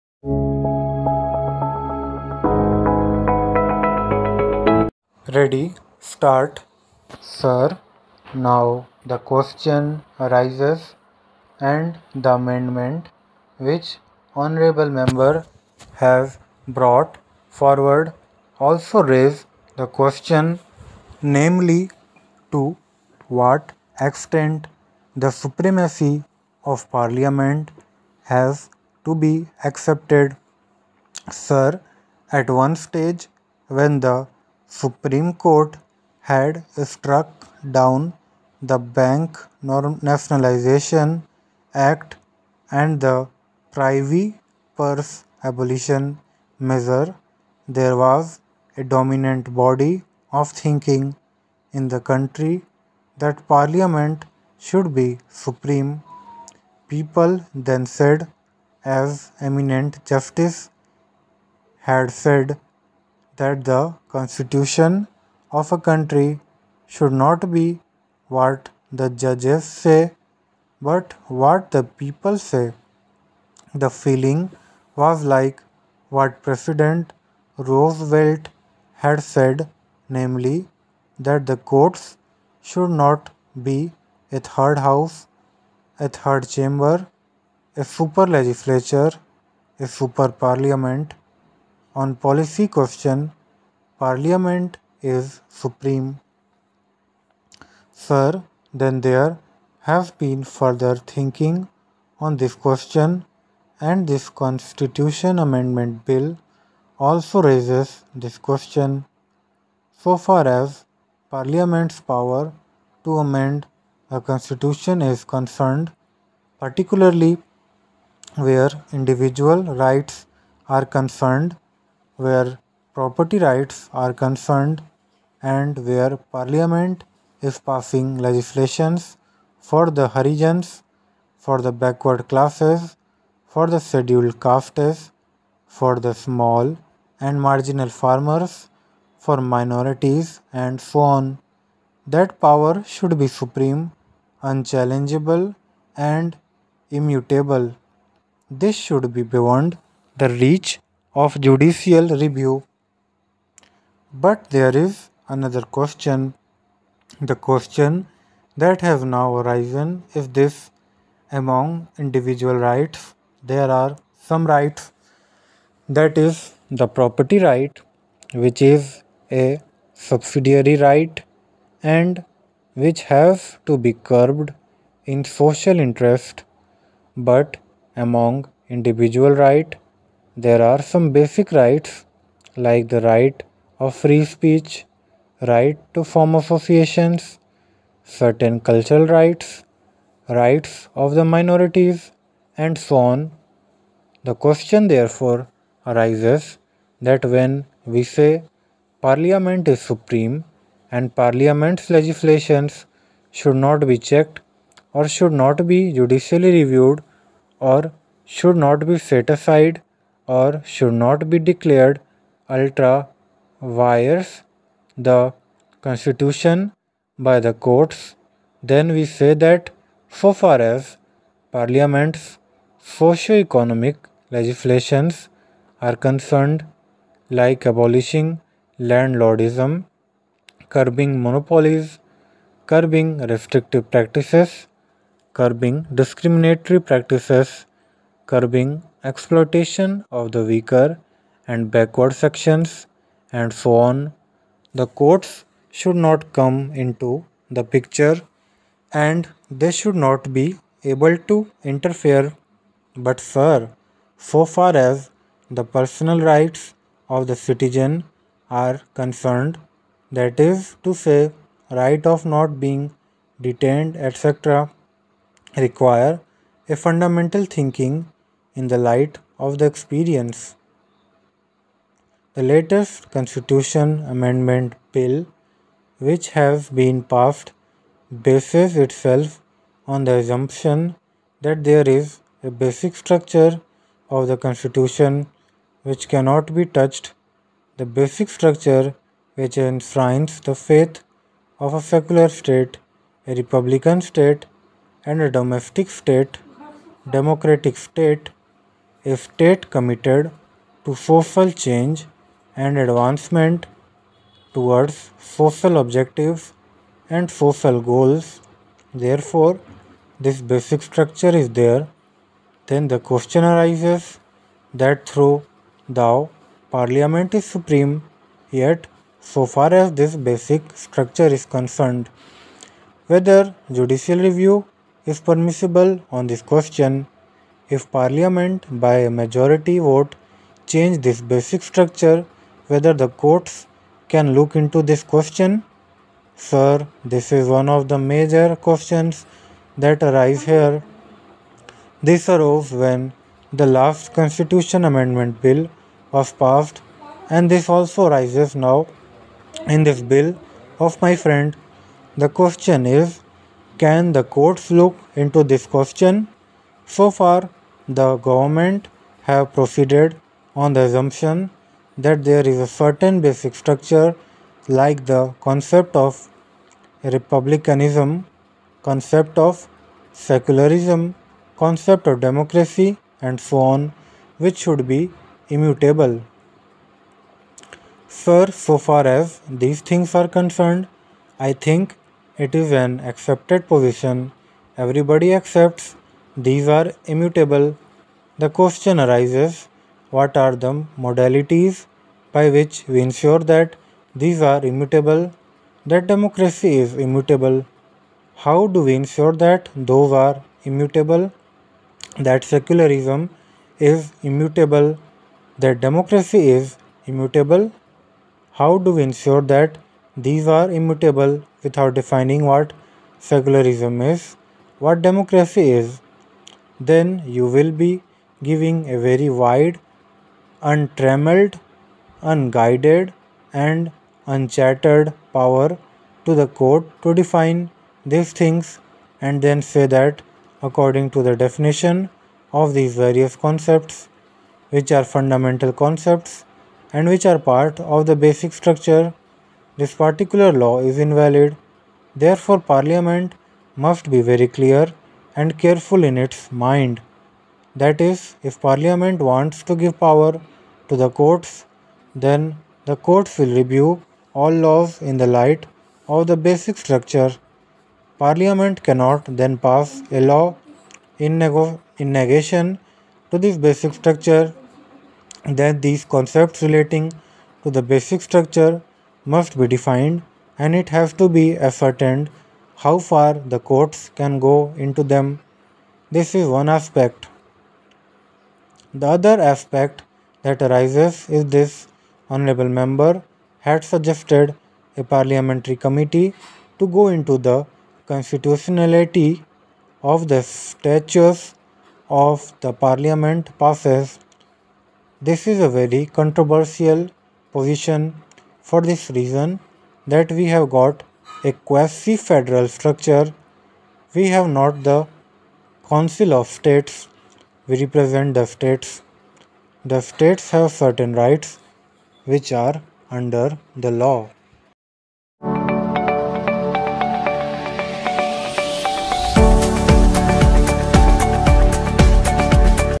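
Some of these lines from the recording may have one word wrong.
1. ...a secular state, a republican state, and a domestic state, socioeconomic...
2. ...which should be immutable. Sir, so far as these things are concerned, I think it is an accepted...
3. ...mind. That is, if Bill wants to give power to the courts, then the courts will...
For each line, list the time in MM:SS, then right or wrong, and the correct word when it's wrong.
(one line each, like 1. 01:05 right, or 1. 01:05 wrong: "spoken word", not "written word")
1. 04:51 wrong: "democratic", not "socioeconomic"
2. 06:14 right
3. 07:26 wrong: "Parliament", not "Bill".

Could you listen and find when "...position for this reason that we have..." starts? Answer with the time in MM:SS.
08:17.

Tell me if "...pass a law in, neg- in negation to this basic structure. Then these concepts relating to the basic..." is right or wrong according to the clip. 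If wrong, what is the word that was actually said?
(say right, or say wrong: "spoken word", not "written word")
right.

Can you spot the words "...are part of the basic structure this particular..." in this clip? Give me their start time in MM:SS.
07:17.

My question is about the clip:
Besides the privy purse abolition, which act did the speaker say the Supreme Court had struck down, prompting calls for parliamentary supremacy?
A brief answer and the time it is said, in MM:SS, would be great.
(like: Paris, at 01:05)
Bank Nationalization Act, at 00:38.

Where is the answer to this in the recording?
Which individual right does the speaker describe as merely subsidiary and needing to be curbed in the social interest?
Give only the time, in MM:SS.
02:46.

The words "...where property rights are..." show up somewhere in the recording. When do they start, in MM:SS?
02:02.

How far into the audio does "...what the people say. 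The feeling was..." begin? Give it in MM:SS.
01:11.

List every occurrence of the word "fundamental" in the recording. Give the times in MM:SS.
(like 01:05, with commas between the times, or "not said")
04:26, 07:15.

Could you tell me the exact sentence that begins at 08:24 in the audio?
We have not the Council of States.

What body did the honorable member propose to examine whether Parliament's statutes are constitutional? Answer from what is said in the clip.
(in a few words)
parliamentary committee.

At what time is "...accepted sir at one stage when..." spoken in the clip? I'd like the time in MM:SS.
00:29.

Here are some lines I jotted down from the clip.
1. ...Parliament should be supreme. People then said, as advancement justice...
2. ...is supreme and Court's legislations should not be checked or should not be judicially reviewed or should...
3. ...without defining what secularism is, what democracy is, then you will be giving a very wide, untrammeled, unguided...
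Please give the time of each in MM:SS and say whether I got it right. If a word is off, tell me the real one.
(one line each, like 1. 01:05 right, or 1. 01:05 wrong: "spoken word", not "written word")
1. 00:53 wrong: "eminent", not "advancement"
2. 03:19 wrong: "Parliament", not "Court"
3. 06:51 right.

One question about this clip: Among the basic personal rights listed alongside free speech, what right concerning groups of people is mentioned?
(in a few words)
right to form associations.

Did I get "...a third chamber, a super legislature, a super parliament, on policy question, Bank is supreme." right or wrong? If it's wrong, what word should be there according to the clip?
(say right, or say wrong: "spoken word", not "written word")
wrong: "Parliament", not "Bank".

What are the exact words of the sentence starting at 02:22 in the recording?
That power should be supreme, unchallengeable and immutable.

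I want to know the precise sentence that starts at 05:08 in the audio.
Therefore, this basic structure is there.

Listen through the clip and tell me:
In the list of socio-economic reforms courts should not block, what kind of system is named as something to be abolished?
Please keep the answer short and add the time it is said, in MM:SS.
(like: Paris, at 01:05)
landlordism, at 03:48.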